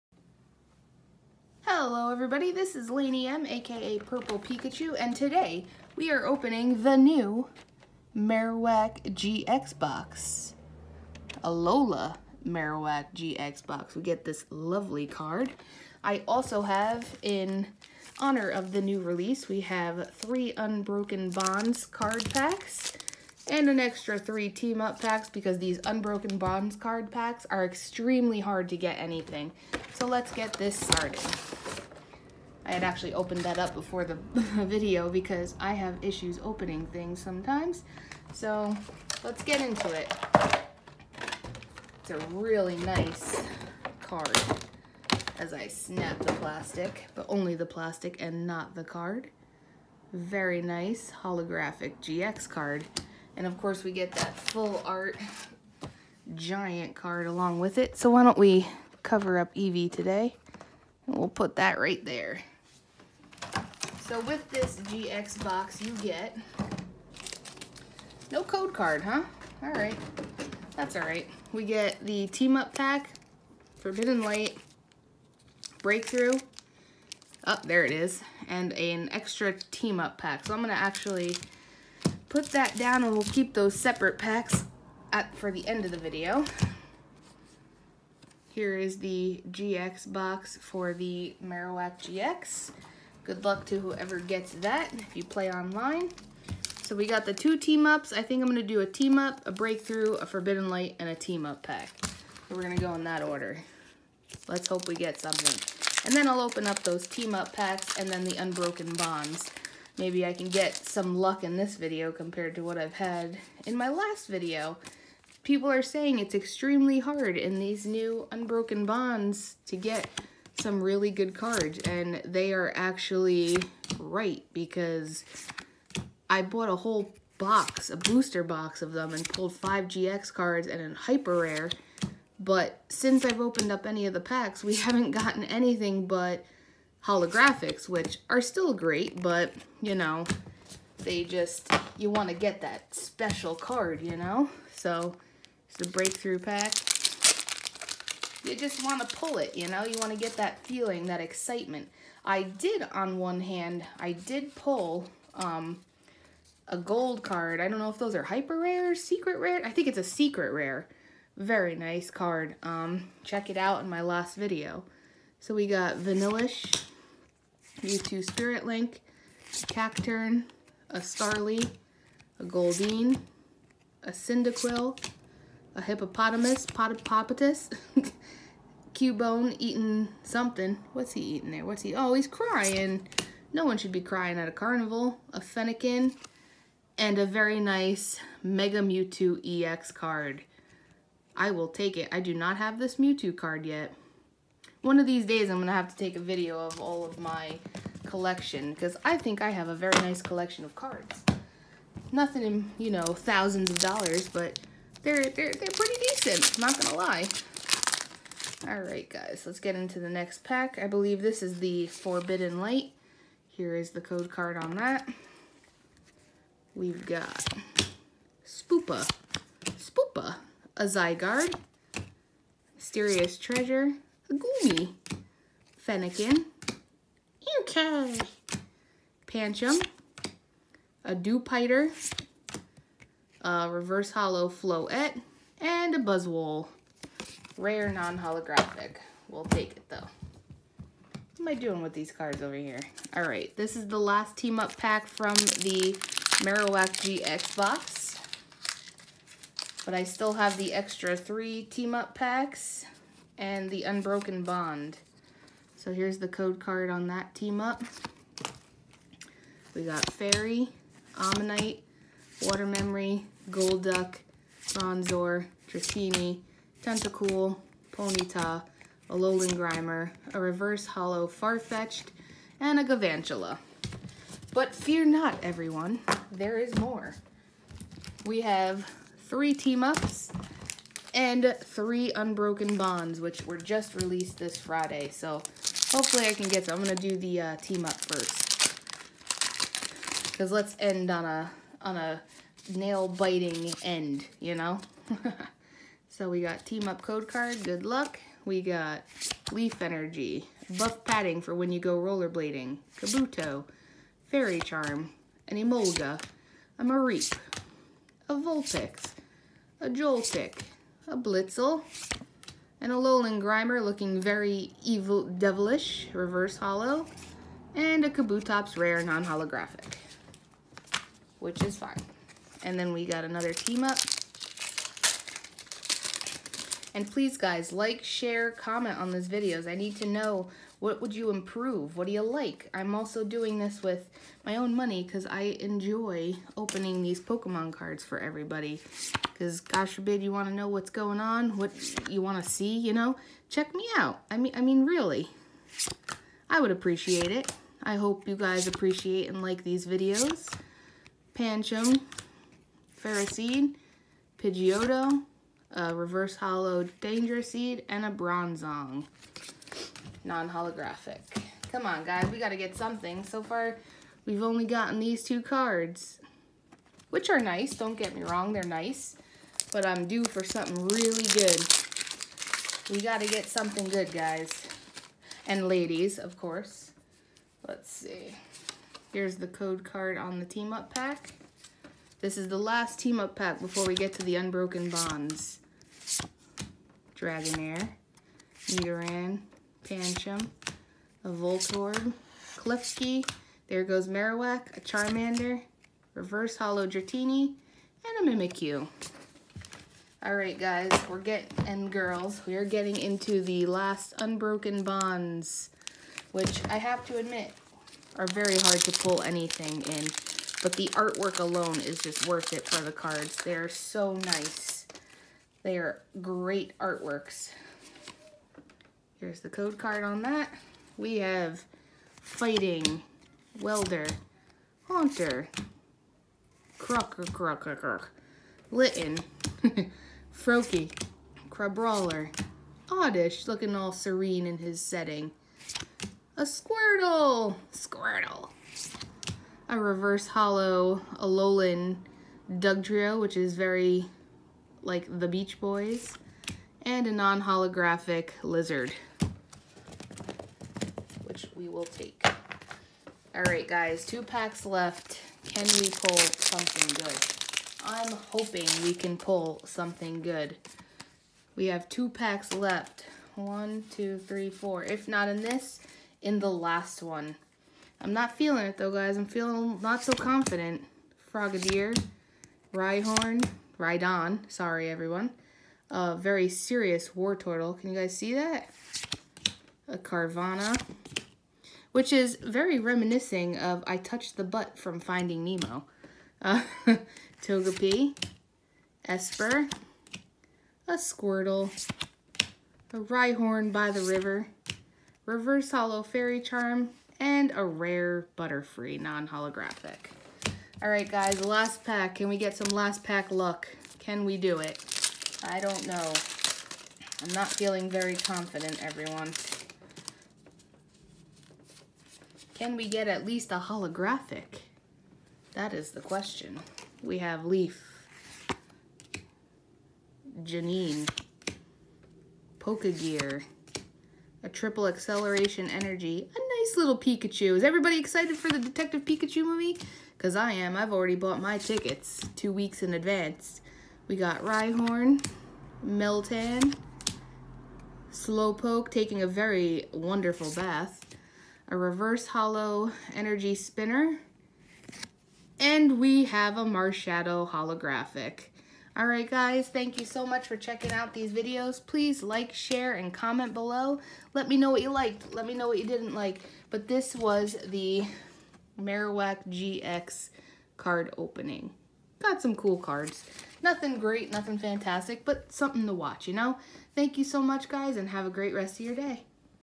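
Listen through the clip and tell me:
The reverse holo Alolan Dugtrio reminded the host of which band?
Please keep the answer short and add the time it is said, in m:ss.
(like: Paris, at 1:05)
The Beach Boys, at 7:25.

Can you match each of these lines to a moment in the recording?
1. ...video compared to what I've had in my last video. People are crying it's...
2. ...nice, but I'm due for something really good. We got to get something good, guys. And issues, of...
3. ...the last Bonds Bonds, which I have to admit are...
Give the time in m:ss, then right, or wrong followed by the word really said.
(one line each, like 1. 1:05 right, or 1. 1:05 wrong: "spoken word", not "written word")
1. 1:51 wrong: "saying", not "crying"
2. 6:08 wrong: "ladies", not "issues"
3. 6:43 wrong: "Unbroken", not "Bonds".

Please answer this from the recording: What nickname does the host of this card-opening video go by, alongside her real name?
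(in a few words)
Purple Pikachu.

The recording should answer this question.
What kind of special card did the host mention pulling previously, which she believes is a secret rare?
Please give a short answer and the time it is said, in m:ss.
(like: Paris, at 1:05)
A gold card, at 2:36.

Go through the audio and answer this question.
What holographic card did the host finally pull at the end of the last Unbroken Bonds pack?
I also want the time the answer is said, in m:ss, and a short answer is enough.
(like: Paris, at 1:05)
Marshadow, at 9:06.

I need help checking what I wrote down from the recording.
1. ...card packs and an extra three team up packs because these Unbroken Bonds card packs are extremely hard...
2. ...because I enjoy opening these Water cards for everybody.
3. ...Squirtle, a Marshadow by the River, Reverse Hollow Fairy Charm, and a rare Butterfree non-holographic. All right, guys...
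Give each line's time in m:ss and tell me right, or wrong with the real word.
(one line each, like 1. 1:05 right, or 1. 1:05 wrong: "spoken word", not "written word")
1. 0:21 right
2. 5:35 wrong: "Pokemon", not "Water"
3. 8:10 wrong: "Rhyhorn", not "Marshadow".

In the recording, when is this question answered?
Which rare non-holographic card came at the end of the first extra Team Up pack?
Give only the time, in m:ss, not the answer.
5:18.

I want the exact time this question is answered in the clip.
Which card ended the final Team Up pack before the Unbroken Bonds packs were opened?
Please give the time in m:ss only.
6:38.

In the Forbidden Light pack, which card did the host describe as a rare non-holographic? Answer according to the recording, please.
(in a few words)
Buzzwole.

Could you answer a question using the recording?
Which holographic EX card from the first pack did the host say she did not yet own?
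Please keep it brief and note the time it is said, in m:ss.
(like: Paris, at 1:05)
Mega Mewtwo EX, at 3:08.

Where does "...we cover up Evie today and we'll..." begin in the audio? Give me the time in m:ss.
0:58.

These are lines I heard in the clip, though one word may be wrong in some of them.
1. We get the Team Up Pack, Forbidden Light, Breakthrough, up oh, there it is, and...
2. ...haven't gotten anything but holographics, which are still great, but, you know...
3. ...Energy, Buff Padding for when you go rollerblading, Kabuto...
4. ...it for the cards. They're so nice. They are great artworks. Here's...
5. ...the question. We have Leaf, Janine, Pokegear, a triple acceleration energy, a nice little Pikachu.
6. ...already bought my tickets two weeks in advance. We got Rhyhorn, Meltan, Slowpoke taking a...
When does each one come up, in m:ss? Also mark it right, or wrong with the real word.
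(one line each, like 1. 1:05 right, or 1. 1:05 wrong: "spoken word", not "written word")
1. 1:11 right
2. 2:14 right
3. 4:59 right
4. 6:52 right
5. 8:35 right
6. 8:50 right.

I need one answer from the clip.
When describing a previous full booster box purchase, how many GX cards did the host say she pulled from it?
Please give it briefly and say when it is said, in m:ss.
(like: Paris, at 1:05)
5, at 2:09.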